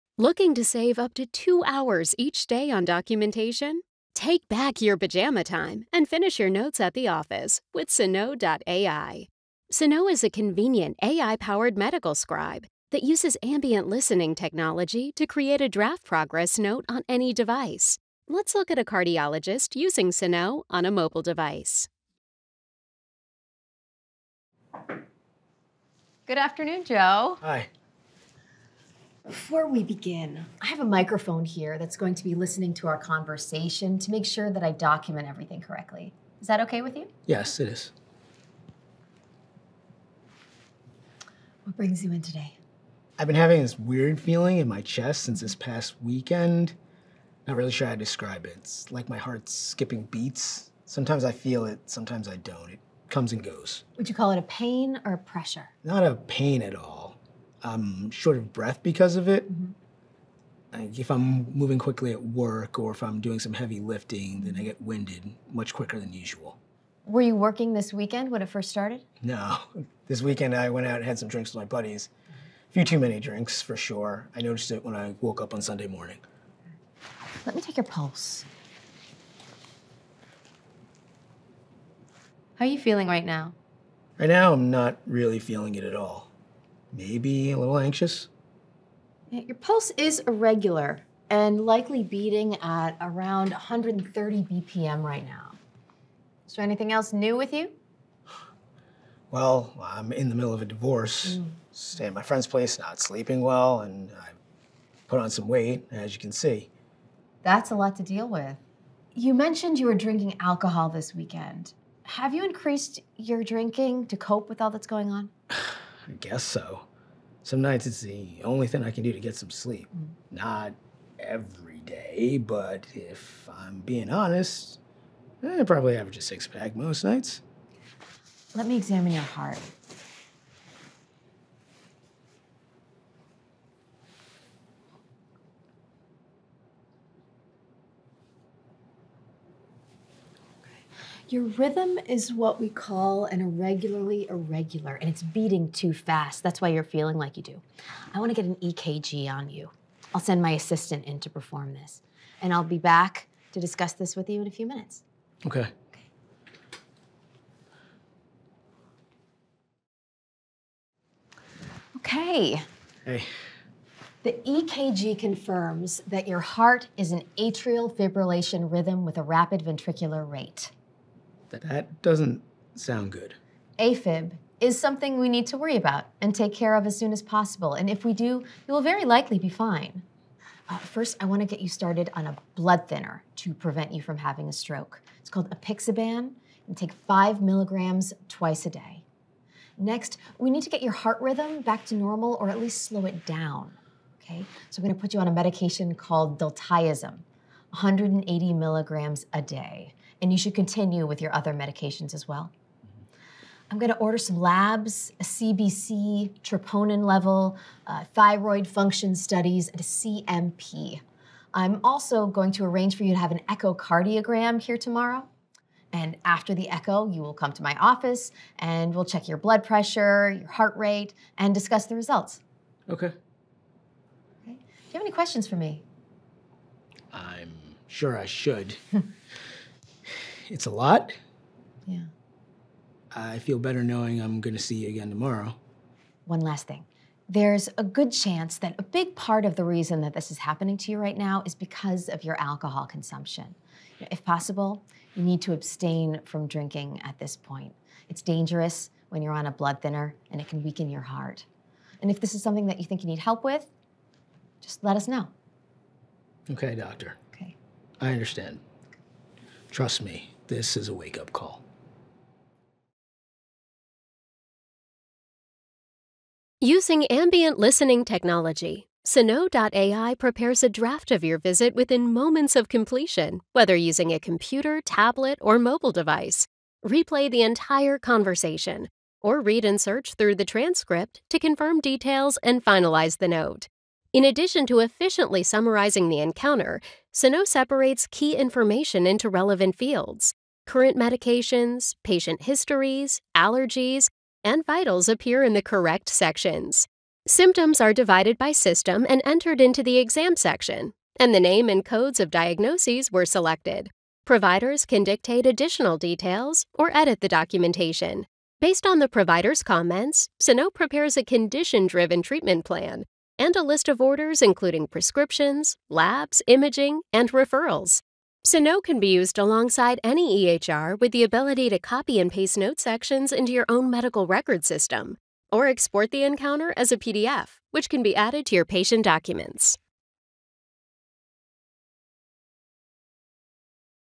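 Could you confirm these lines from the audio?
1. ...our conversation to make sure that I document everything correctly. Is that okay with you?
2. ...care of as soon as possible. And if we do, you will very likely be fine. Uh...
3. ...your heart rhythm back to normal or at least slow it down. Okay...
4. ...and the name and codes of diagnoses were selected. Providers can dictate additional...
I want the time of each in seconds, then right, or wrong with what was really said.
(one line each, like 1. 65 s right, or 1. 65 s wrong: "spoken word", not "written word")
1. 32 s right
2. 176 s right
3. 190 s right
4. 301 s right.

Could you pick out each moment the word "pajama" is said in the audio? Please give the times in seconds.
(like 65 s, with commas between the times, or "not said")
4 s.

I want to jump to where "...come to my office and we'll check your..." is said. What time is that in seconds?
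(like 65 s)
217 s.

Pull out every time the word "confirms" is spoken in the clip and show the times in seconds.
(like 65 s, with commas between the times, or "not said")
165 s, 281 s.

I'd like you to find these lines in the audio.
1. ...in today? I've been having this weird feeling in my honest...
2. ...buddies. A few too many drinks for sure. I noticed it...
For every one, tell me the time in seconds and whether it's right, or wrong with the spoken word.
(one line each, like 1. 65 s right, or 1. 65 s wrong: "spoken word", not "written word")
1. 42 s wrong: "chest", not "honest"
2. 71 s right.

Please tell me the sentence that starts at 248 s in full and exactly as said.
It's dangerous when you're on a blood thinner and it can weaken your heart.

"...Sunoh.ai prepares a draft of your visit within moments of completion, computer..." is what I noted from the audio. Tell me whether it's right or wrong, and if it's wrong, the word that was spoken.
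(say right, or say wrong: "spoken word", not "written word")
wrong: "whether", not "computer".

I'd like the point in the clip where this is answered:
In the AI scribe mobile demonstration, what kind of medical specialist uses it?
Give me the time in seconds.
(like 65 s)
18 s.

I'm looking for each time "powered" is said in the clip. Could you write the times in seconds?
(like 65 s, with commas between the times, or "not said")
11 s.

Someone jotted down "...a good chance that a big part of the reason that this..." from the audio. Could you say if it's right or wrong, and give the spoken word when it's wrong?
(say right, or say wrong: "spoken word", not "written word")
right.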